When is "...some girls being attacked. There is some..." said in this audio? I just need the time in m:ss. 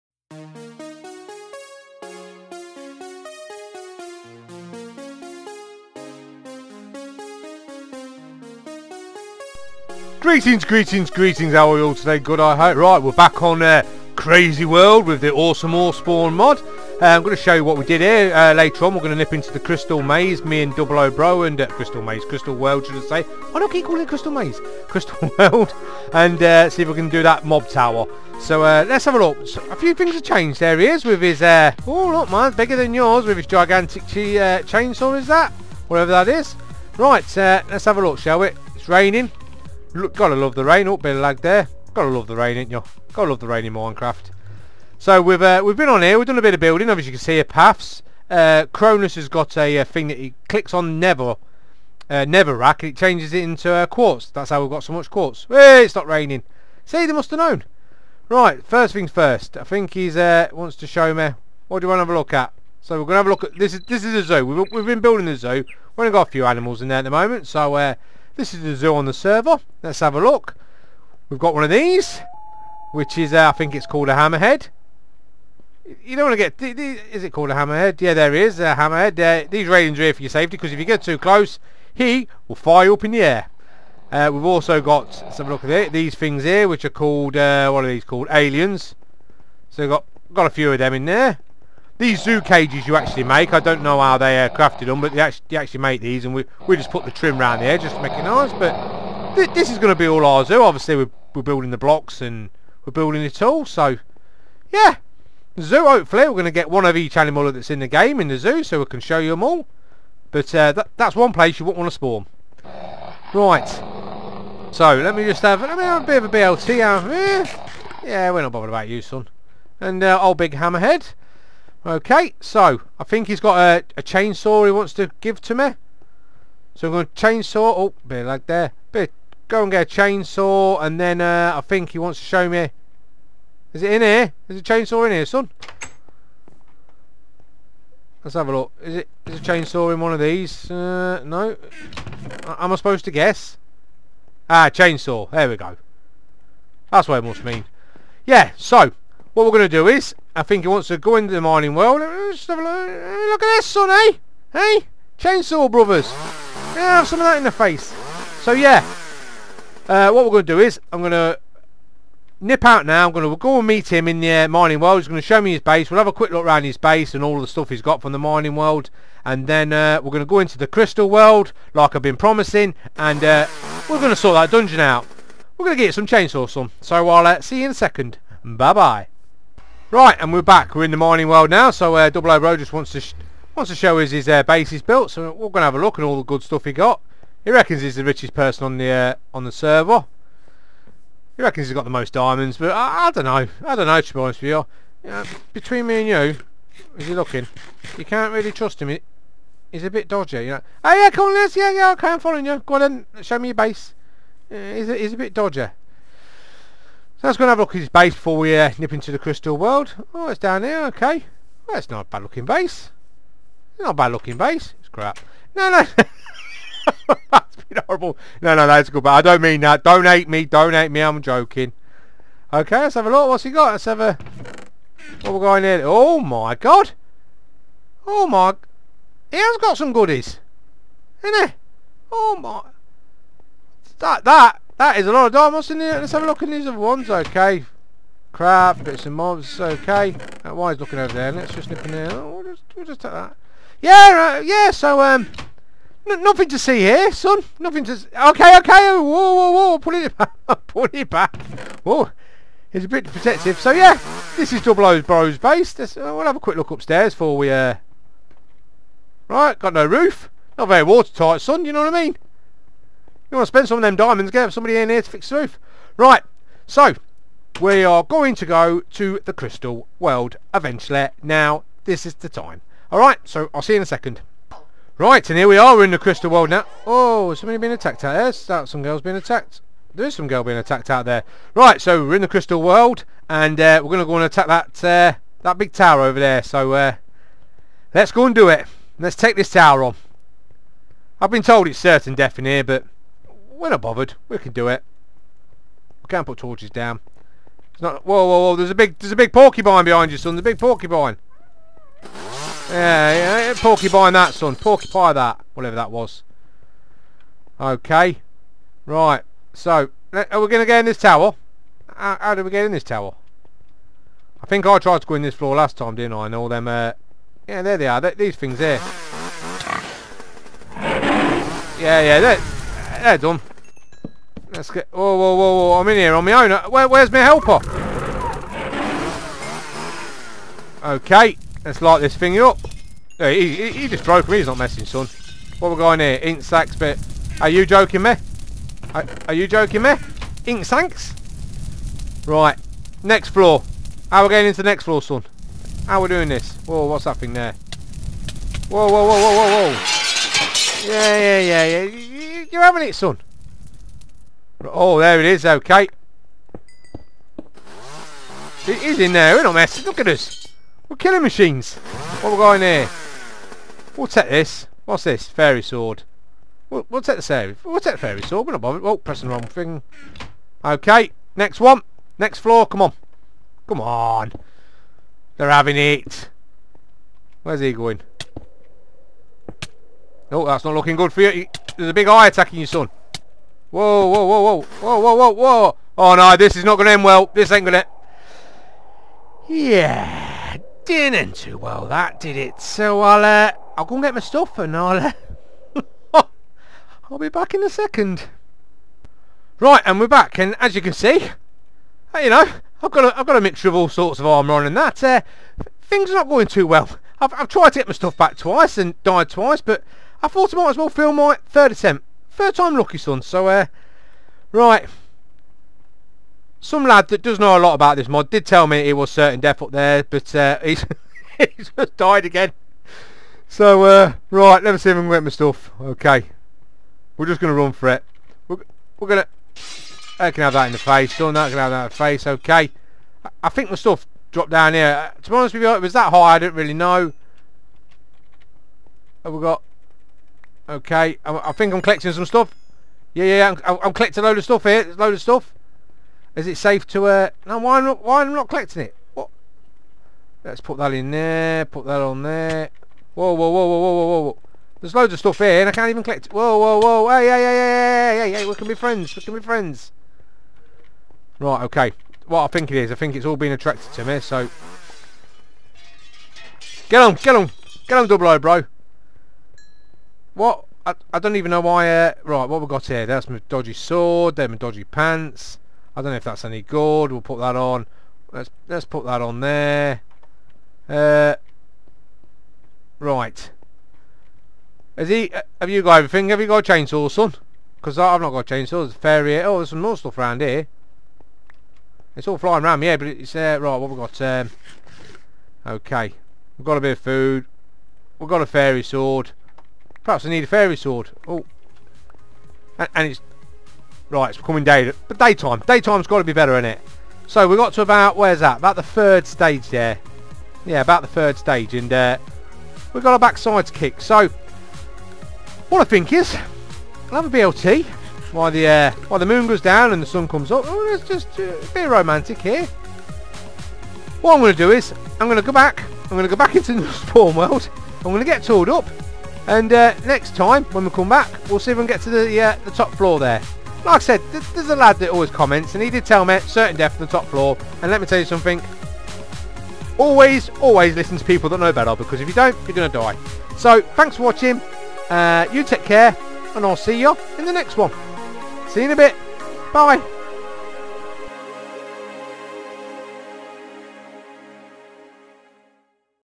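4:38.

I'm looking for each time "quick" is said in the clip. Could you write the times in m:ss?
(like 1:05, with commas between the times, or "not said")
2:46, 4:16.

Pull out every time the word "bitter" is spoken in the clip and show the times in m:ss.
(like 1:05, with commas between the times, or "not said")
not said.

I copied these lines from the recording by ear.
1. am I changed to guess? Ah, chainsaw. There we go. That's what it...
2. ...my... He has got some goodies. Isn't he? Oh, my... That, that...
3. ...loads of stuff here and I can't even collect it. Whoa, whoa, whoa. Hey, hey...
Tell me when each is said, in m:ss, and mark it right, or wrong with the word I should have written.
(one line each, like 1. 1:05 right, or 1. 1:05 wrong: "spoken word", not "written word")
1. 2:22 wrong: "supposed", not "changed"
2. 3:48 right
3. 7:34 right.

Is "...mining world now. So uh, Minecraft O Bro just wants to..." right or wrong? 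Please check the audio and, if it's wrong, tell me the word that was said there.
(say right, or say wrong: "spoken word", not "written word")
wrong: "Double", not "Minecraft".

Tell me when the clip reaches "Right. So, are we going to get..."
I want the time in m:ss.
5:08.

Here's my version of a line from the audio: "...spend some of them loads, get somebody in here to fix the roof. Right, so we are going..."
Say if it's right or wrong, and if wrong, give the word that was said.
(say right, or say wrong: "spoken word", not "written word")
wrong: "diamonds", not "loads".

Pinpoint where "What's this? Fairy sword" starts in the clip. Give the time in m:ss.
6:04.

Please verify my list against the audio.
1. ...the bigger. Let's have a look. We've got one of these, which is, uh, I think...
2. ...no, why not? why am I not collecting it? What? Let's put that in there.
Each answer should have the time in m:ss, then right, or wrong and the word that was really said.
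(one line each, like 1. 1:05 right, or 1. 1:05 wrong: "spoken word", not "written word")
1. 1:09 wrong: "server", not "bigger"
2. 7:27 right.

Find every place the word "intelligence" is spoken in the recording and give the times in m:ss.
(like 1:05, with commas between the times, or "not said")
not said.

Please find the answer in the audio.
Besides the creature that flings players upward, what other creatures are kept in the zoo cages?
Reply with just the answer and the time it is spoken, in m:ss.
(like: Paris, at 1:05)
Aliens, at 1:28.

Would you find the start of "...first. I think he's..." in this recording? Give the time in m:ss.
0:59.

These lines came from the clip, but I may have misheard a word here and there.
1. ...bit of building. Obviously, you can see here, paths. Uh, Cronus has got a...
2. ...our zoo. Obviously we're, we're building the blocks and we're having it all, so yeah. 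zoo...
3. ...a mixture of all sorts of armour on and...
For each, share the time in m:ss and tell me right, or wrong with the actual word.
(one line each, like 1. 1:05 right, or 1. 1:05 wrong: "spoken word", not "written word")
1. 0:46 right
2. 1:40 wrong: "building", not "having"
3. 6:43 right.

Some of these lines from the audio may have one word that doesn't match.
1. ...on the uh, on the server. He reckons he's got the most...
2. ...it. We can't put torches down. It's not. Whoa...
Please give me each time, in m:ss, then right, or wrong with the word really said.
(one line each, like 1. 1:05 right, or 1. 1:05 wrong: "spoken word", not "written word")
1. 3:08 right
2. 4:54 right.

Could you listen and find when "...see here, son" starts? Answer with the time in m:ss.
4:06.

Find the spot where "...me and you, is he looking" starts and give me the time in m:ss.
3:15.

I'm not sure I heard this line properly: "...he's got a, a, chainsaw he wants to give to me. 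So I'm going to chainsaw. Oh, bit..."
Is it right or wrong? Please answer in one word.
right.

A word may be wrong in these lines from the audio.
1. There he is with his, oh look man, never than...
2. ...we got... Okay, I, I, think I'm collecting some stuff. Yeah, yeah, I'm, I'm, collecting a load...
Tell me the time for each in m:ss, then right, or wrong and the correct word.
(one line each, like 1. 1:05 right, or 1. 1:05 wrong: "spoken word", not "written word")
1. 0:30 wrong: "bigger", not "never"
2. 7:19 right.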